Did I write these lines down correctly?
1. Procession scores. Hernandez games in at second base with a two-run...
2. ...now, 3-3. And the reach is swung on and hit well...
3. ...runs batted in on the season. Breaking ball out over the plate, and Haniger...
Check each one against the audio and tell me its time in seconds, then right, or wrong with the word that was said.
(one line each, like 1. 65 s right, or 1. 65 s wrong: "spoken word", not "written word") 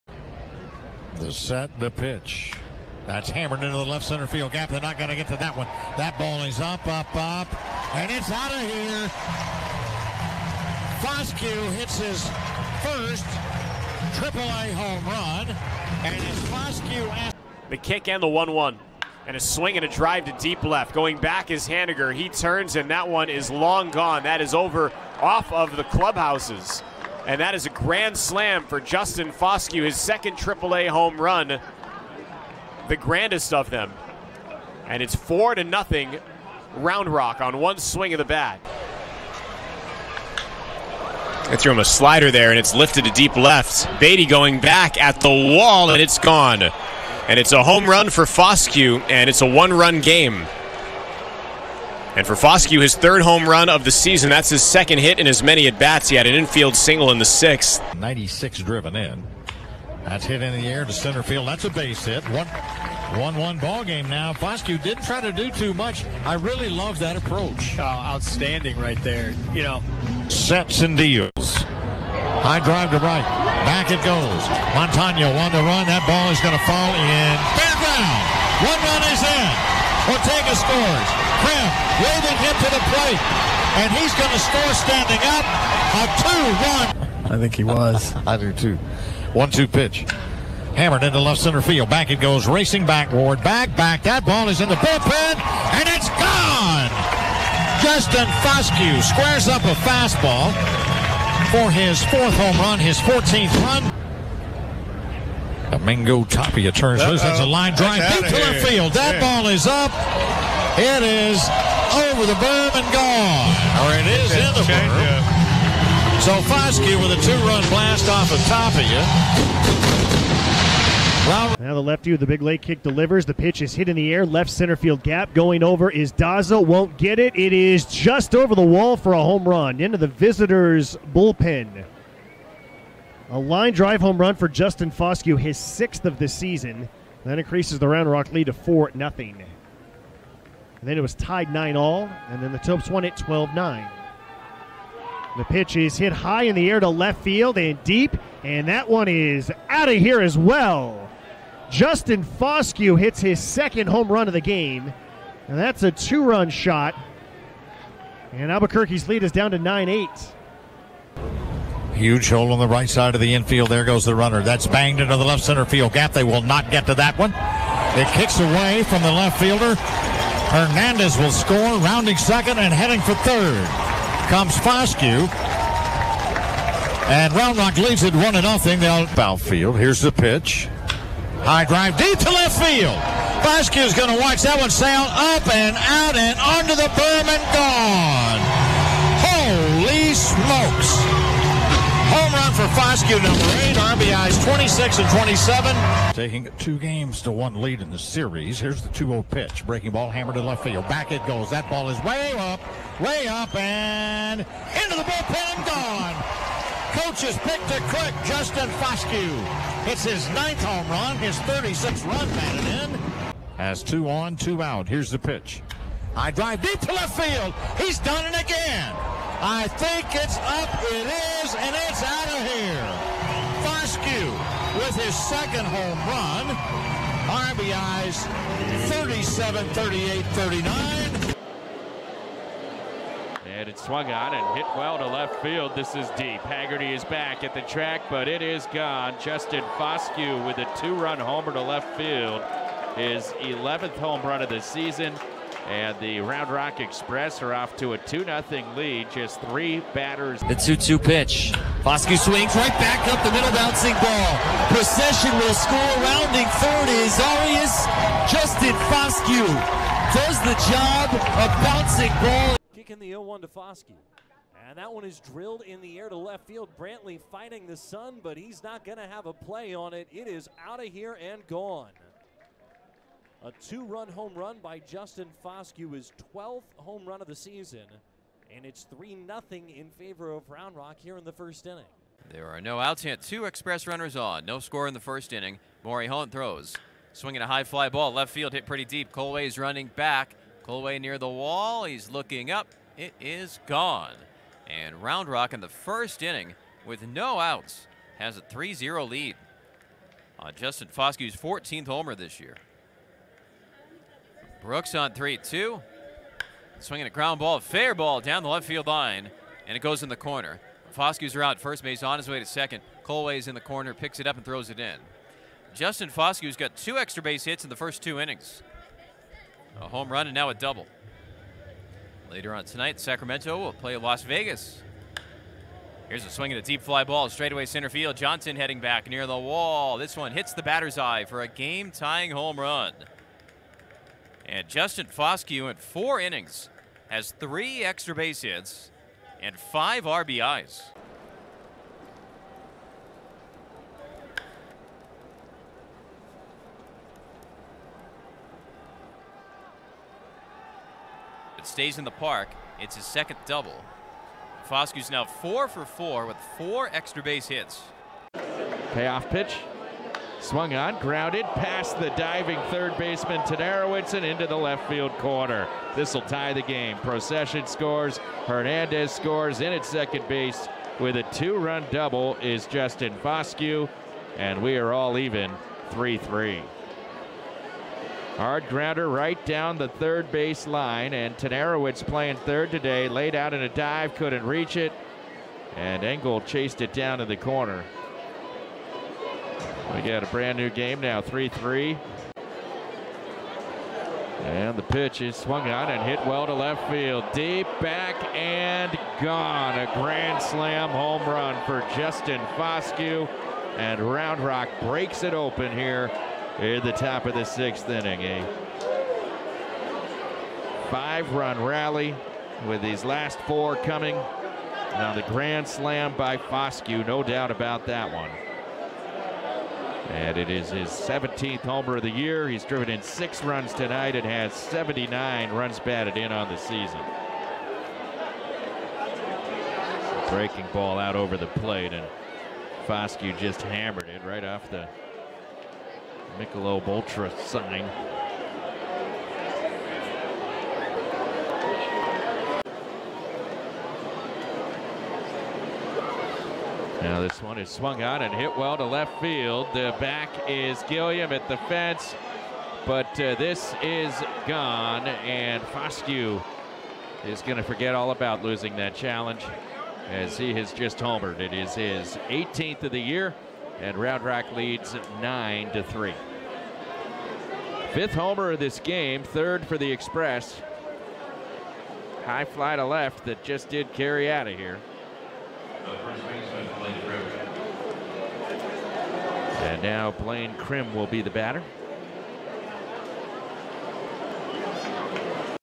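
1. 366 s wrong: "scores", not "games"
2. 391 s wrong: "pitch", not "reach"
3. 425 s wrong: "Foscue", not "Haniger".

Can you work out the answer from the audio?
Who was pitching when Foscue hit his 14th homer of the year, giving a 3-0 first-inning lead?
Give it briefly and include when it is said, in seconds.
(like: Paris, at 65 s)
Maury Hunt, at 285 s.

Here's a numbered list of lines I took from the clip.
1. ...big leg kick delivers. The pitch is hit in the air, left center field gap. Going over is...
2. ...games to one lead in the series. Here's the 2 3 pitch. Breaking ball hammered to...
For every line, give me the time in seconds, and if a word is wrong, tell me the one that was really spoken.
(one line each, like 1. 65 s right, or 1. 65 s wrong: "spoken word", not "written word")
1. 122 s right
2. 196 s wrong: "0", not "3".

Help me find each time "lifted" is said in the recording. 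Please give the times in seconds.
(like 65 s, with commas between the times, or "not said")
42 s.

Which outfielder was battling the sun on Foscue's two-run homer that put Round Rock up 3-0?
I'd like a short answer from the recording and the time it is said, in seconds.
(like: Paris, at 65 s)
Brantley, at 266 s.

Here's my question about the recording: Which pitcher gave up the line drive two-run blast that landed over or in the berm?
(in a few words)
Domingo Tapia.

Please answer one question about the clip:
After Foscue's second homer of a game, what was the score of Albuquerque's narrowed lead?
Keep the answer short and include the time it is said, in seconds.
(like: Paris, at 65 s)
9-8, at 159 s.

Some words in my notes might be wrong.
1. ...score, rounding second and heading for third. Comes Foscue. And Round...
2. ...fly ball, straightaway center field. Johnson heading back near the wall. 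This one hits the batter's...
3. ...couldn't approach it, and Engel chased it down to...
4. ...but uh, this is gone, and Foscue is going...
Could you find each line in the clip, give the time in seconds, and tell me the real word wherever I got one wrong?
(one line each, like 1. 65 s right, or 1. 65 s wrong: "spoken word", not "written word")
1. 171 s right
2. 326 s right
3. 384 s wrong: "reach", not "approach"
4. 452 s right.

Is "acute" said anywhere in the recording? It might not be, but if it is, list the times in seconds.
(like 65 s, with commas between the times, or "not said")
not said.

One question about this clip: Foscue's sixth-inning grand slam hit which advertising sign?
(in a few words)
Michelob Ultra.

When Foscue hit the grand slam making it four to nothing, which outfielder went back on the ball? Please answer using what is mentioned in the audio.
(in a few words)
Haniger.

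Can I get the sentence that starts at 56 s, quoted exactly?
He had an infield single in the sixth.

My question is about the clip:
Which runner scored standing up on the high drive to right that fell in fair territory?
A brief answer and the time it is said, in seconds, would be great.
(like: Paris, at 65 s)
Ortega, at 80 s.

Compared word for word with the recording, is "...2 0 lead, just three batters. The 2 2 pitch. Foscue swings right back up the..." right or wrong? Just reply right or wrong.
right.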